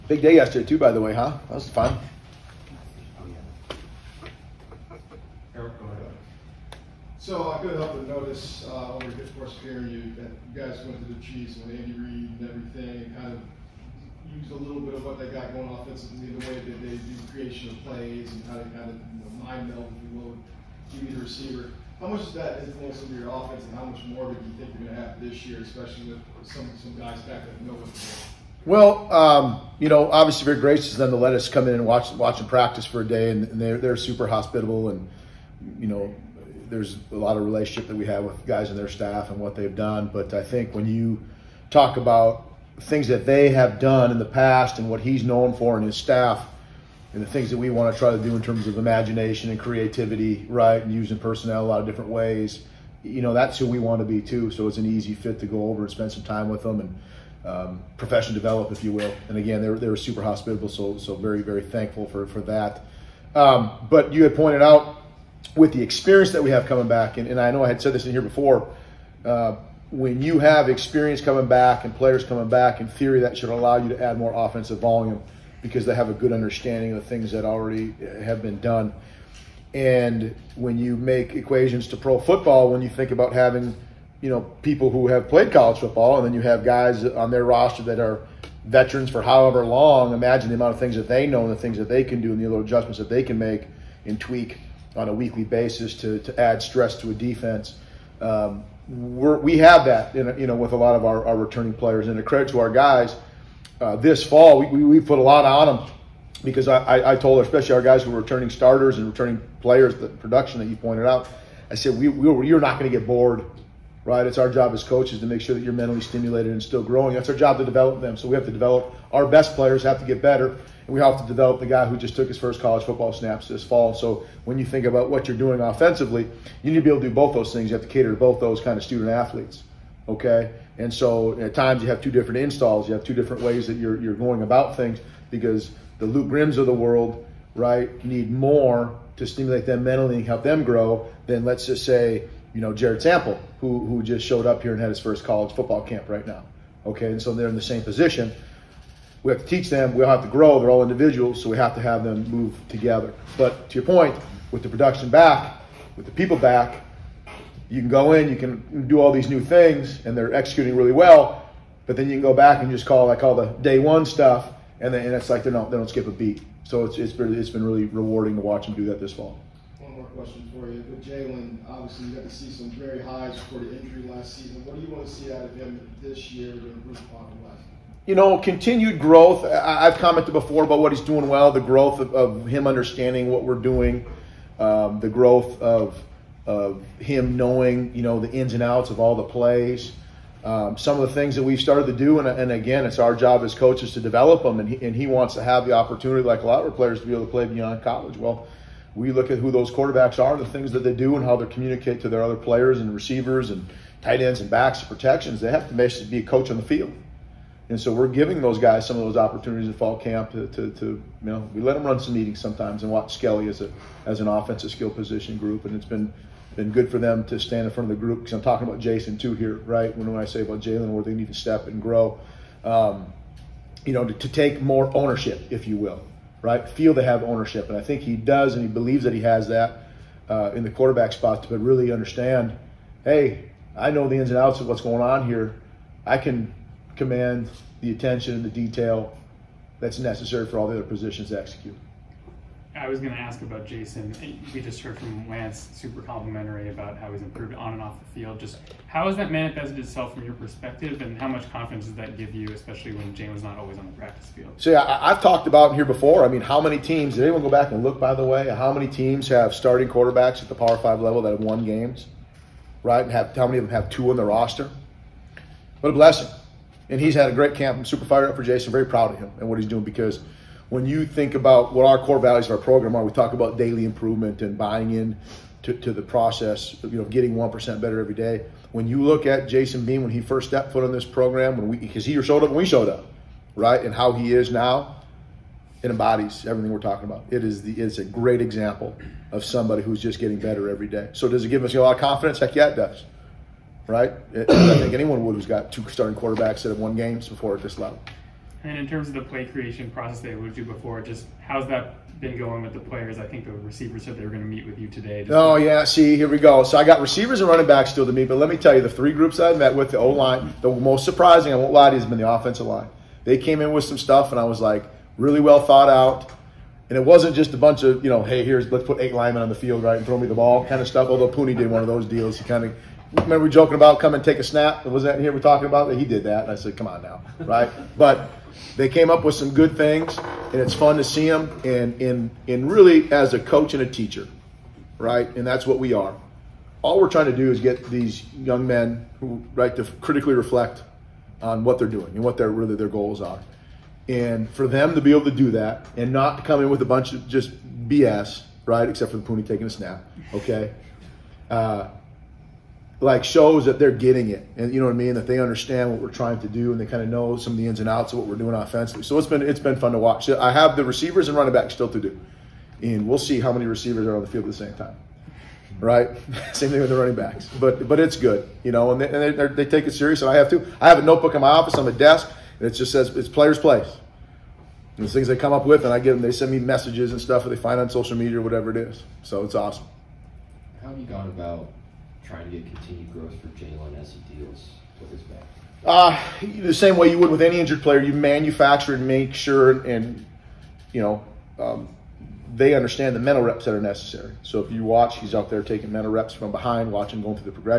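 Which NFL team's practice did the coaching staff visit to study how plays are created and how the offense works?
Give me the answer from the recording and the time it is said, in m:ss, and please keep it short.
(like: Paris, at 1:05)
Chiefs, at 0:11.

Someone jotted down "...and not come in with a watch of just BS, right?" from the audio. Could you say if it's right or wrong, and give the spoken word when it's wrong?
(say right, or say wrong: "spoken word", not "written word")
wrong: "bunch", not "watch".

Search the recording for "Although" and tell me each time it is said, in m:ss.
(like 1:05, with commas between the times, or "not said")
5:21.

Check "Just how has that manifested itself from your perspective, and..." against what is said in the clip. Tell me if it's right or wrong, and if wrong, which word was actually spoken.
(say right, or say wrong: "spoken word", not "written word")
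right.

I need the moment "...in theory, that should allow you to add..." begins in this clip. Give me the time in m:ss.
1:12.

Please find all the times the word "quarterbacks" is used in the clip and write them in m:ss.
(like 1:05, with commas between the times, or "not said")
3:19, 3:50, 4:19, 4:56.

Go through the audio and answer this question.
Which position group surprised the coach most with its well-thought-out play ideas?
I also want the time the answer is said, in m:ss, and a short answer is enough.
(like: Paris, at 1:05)
Offensive line, at 5:12.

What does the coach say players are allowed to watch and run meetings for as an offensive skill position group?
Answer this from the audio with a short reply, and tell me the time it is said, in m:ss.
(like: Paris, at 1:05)
Skelly, at 3:33.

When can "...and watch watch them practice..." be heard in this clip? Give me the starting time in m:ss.
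0:31.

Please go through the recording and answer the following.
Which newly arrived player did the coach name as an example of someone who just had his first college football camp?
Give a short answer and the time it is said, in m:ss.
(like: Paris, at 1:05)
Jared Sample, at 2:22.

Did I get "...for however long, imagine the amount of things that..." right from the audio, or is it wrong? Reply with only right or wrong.
right.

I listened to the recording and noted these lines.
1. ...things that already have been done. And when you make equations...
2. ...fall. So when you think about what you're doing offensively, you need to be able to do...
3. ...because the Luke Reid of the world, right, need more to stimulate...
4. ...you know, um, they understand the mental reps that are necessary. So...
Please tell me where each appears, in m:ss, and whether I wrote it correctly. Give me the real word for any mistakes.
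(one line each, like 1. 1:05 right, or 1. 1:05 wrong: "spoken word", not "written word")
1. 1:17 right
2. 2:03 right
3. 2:15 wrong: "Grimms", not "Reid"
4. 6:30 right.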